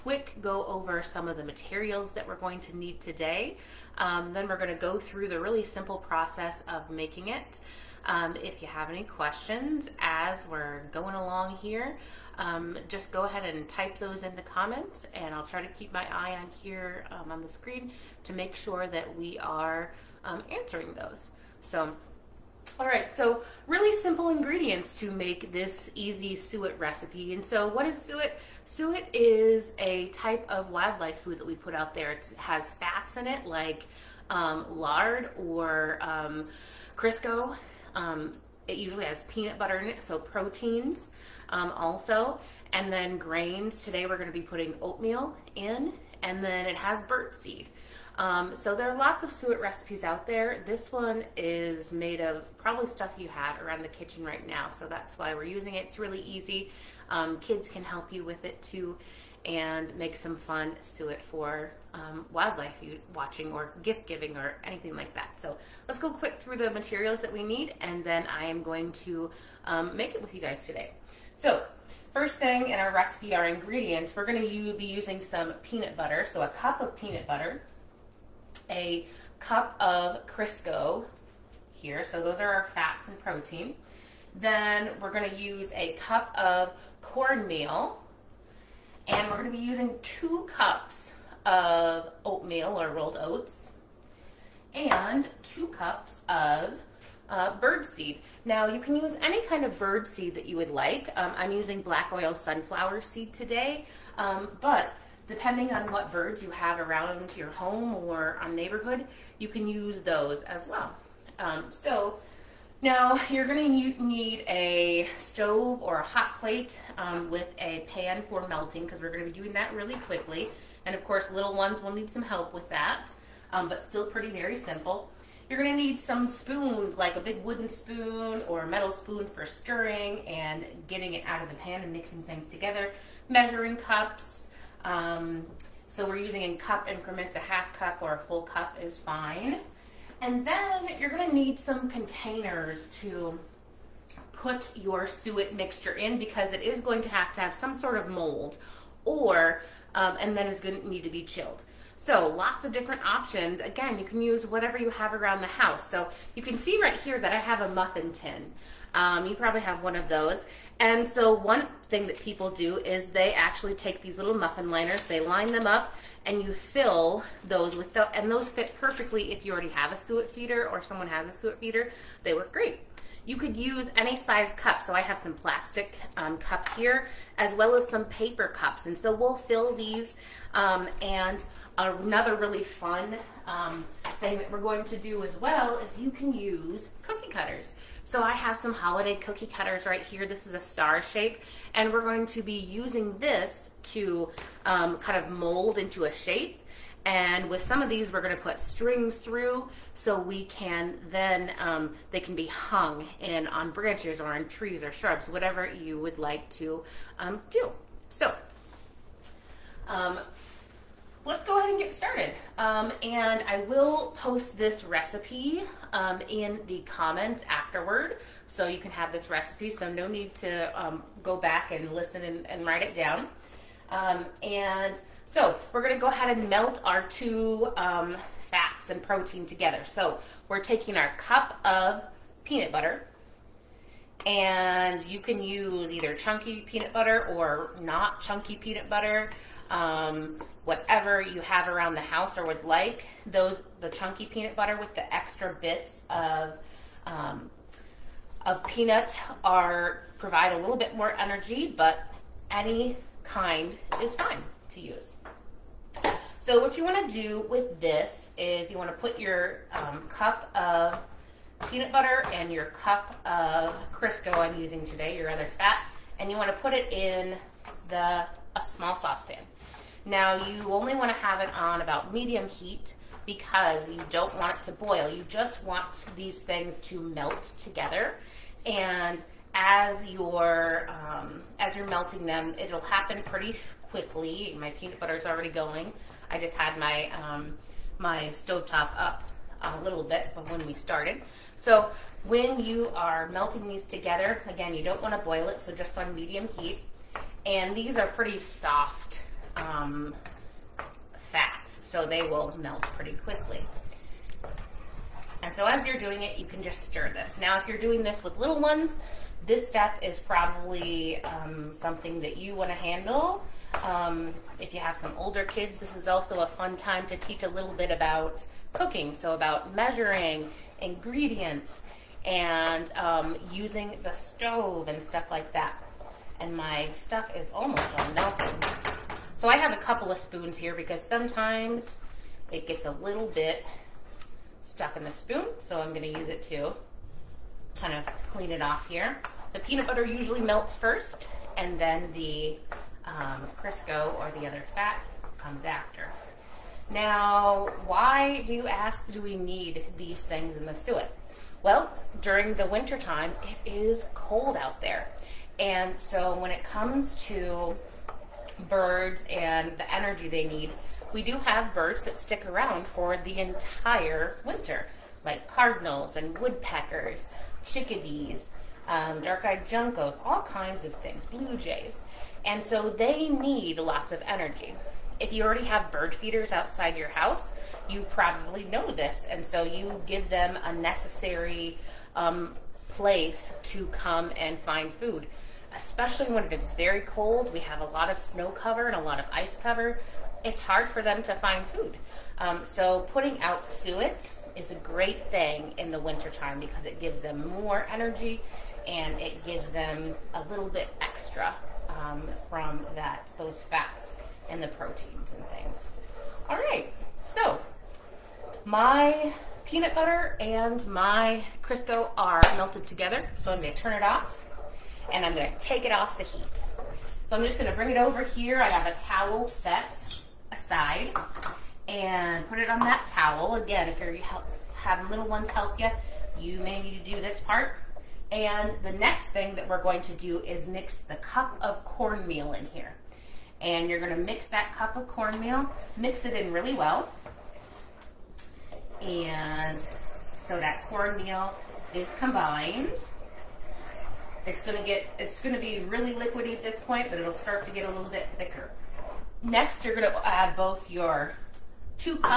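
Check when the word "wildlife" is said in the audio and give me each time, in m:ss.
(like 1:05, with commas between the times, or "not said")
0:30, 1:02.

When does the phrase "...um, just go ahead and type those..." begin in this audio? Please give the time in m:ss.
0:12.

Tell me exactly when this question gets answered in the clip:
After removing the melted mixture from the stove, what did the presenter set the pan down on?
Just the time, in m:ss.
7:02.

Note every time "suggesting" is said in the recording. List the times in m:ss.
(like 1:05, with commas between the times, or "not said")
not said.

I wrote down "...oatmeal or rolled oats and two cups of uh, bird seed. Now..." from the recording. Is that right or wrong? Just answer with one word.
right.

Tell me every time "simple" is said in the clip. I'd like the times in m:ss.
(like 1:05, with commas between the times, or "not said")
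0:05, 0:24, 2:04.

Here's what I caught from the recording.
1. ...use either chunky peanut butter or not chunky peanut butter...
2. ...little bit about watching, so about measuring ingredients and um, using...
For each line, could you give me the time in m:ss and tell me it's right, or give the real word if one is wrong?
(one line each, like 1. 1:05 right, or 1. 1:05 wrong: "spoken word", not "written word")
1. 3:55 right
2. 5:17 wrong: "cooking", not "watching".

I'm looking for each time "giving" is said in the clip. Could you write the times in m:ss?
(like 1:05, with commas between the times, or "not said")
1:04.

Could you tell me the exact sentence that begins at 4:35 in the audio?
You just want these things to melt together and as you're um, as you're melting them, it'll happen pretty quickly.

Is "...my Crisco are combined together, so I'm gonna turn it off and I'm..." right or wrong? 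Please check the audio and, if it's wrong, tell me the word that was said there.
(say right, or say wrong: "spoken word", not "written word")
wrong: "melted", not "combined".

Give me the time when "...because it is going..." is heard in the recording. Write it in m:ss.
2:26.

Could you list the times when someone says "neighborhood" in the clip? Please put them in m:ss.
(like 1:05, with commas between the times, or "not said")
1:48.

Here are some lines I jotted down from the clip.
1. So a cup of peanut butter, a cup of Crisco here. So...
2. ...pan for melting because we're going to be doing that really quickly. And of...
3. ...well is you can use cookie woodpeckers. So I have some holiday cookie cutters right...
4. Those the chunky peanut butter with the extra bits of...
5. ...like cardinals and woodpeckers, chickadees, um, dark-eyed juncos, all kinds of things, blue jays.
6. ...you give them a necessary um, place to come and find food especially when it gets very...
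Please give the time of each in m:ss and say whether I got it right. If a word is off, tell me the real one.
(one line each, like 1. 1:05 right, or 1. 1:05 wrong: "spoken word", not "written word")
1. 1:16 right
2. 1:57 right
3. 3:05 wrong: "cutters", not "woodpeckers"
4. 4:03 right
5. 6:05 right
6. 6:19 right.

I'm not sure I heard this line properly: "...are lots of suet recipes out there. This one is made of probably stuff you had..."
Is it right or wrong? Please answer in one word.
right.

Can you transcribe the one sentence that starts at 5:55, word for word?
And so when it comes to birds and the energy they need.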